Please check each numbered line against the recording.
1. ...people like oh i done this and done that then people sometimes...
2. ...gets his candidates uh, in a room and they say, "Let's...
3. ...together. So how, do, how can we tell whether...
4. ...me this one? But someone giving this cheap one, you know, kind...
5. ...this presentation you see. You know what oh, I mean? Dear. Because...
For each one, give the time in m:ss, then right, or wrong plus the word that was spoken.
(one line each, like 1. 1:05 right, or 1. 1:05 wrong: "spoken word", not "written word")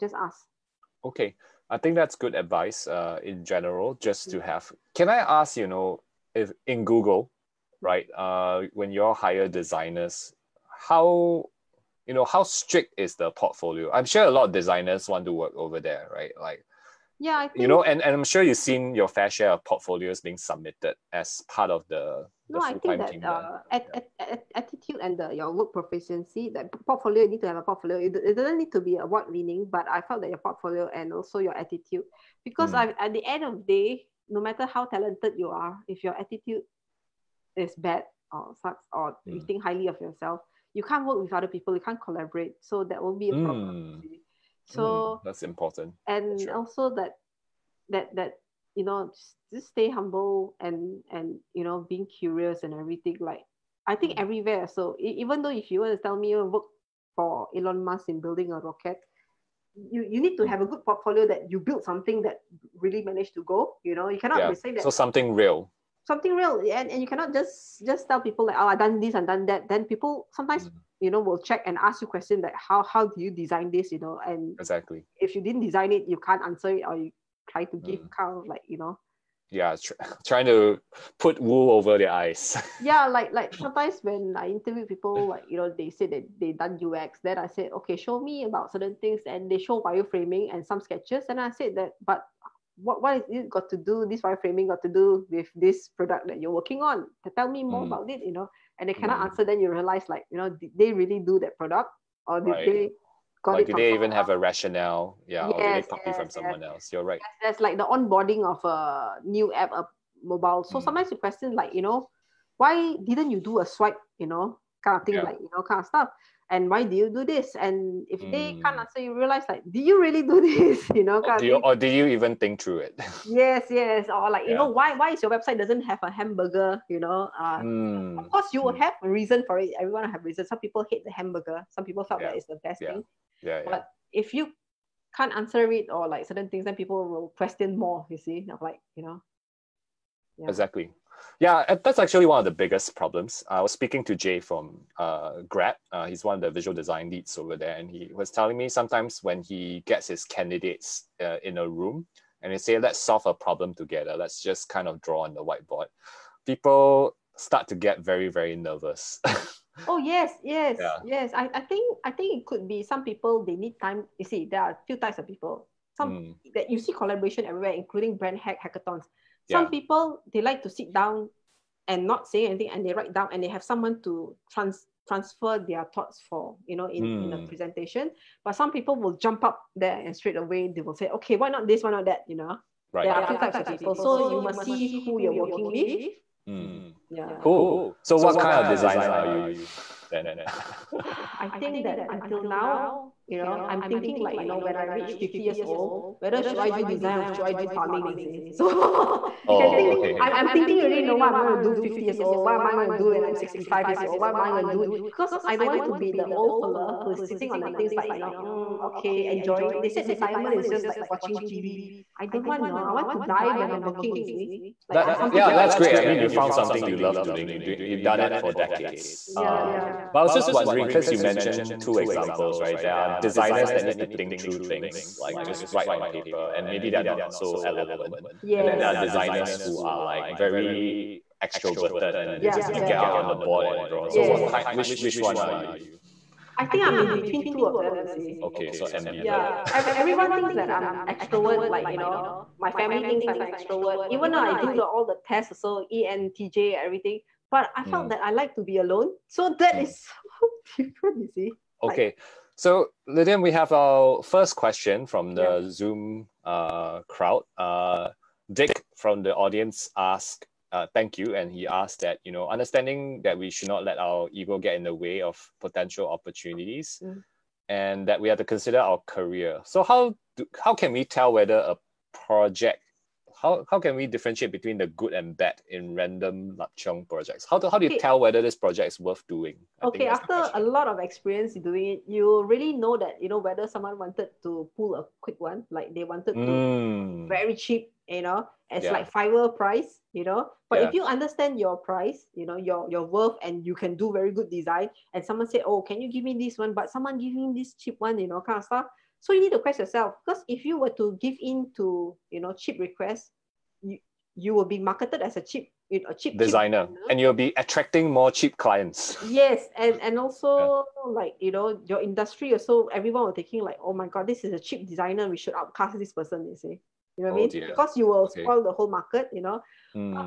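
1. 1:08 right
2. 2:29 right
3. 4:29 wrong: "career", not "together"
4. 4:56 right
5. 5:15 wrong: "person", not "presentation".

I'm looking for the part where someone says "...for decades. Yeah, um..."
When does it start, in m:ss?
3:38.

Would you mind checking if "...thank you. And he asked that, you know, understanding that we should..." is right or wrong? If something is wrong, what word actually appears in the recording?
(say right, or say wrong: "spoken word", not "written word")
right.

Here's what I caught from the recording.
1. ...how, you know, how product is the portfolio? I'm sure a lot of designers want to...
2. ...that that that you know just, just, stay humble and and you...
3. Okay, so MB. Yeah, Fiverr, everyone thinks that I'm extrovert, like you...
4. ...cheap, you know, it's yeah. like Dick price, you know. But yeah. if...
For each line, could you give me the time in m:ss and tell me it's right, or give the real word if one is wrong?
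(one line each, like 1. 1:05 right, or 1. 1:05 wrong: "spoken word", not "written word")
1. 0:10 wrong: "strict", not "product"
2. 0:46 right
3. 3:58 wrong: "Every", not "Fiverr"
4. 4:47 wrong: "Fiverr", not "Dick".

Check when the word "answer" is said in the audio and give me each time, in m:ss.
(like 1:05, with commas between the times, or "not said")
1:16, 1:39, 1:58, 2:15.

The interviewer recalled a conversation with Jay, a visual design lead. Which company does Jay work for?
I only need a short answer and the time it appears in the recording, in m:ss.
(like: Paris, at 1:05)
Grab, at 2:25.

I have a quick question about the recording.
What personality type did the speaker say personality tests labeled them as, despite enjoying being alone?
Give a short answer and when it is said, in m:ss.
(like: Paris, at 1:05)
ENTJ, at 4:05.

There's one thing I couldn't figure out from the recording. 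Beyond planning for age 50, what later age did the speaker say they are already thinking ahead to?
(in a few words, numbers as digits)
65.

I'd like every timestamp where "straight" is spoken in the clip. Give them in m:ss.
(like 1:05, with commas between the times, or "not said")
3:00.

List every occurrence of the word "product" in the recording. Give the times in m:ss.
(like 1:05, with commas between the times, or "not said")
1:35, 1:41.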